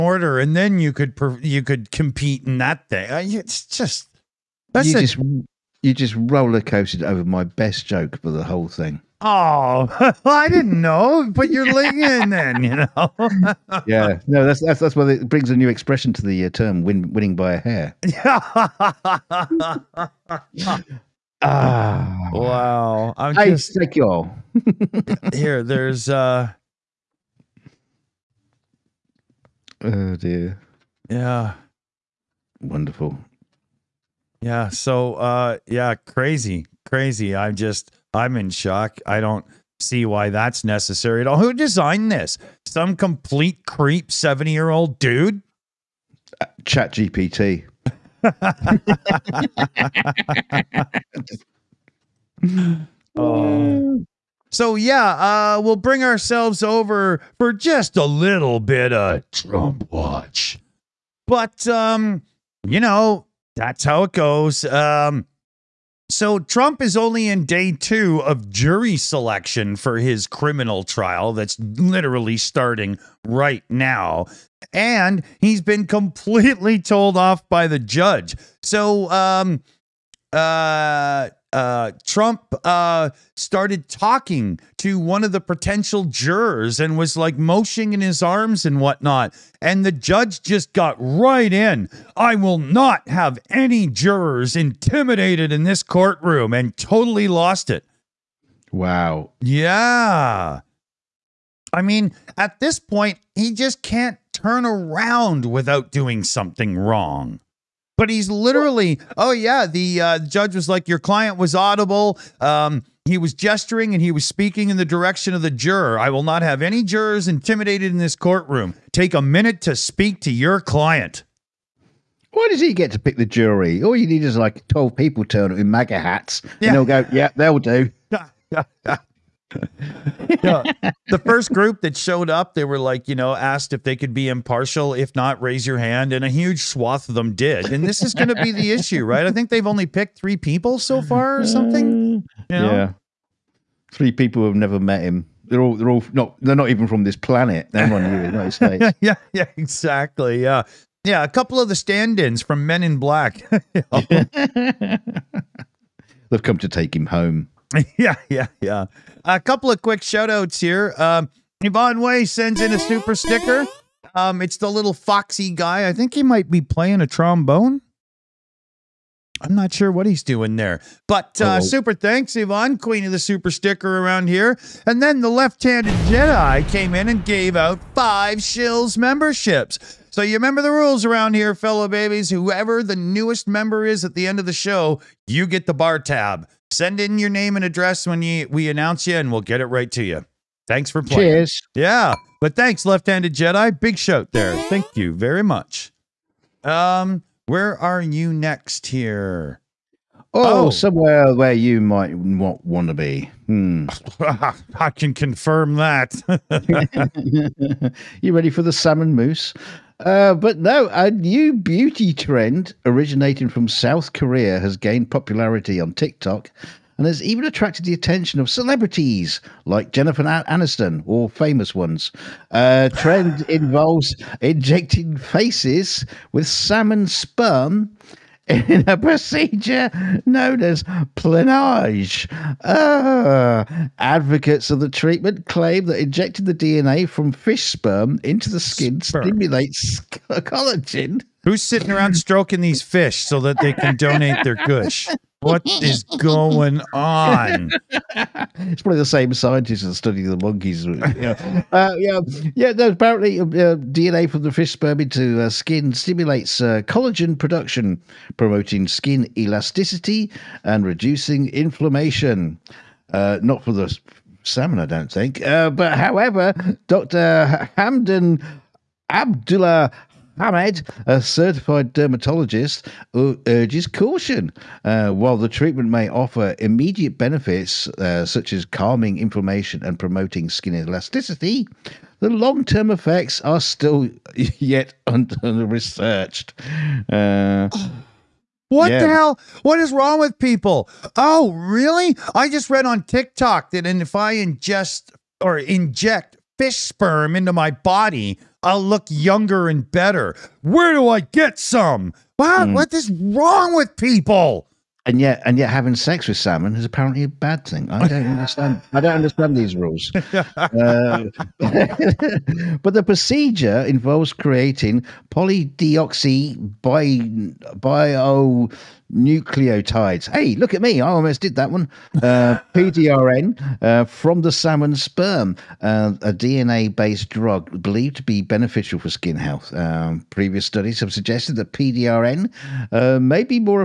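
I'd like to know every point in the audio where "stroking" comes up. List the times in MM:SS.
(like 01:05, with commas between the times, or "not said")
04:02.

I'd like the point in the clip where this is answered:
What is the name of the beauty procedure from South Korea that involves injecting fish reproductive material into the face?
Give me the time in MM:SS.
03:51.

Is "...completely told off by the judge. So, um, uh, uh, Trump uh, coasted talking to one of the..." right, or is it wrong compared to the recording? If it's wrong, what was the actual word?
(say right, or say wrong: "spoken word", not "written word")
wrong: "started", not "coasted".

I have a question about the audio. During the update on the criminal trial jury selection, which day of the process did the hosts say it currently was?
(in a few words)
Day 2.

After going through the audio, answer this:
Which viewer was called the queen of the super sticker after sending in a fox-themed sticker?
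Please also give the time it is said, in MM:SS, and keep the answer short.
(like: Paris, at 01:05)
Yvonne Way, at 02:41.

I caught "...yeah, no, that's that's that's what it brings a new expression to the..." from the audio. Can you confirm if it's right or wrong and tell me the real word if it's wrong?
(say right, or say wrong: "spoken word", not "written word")
right.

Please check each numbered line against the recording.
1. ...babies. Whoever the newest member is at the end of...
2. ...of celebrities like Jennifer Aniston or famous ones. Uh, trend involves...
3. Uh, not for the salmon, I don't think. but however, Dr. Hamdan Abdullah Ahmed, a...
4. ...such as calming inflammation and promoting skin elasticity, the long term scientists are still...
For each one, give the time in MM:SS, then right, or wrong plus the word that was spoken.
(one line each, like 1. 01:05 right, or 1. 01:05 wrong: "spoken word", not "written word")
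1. 03:01 right
2. 03:38 right
3. 04:23 right
4. 04:38 wrong: "effects", not "scientists".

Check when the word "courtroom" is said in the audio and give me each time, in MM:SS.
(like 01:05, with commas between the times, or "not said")
01:35, 01:58.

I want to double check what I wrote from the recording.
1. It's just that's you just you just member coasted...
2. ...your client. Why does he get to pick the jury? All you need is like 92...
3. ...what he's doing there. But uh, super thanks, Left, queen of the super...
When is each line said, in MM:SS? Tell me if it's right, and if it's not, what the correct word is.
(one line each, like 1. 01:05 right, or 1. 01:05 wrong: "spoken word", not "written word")
1. 00:03 wrong: "roller", not "member"
2. 02:00 wrong: "12", not "92"
3. 02:49 wrong: "Yvonne", not "Left".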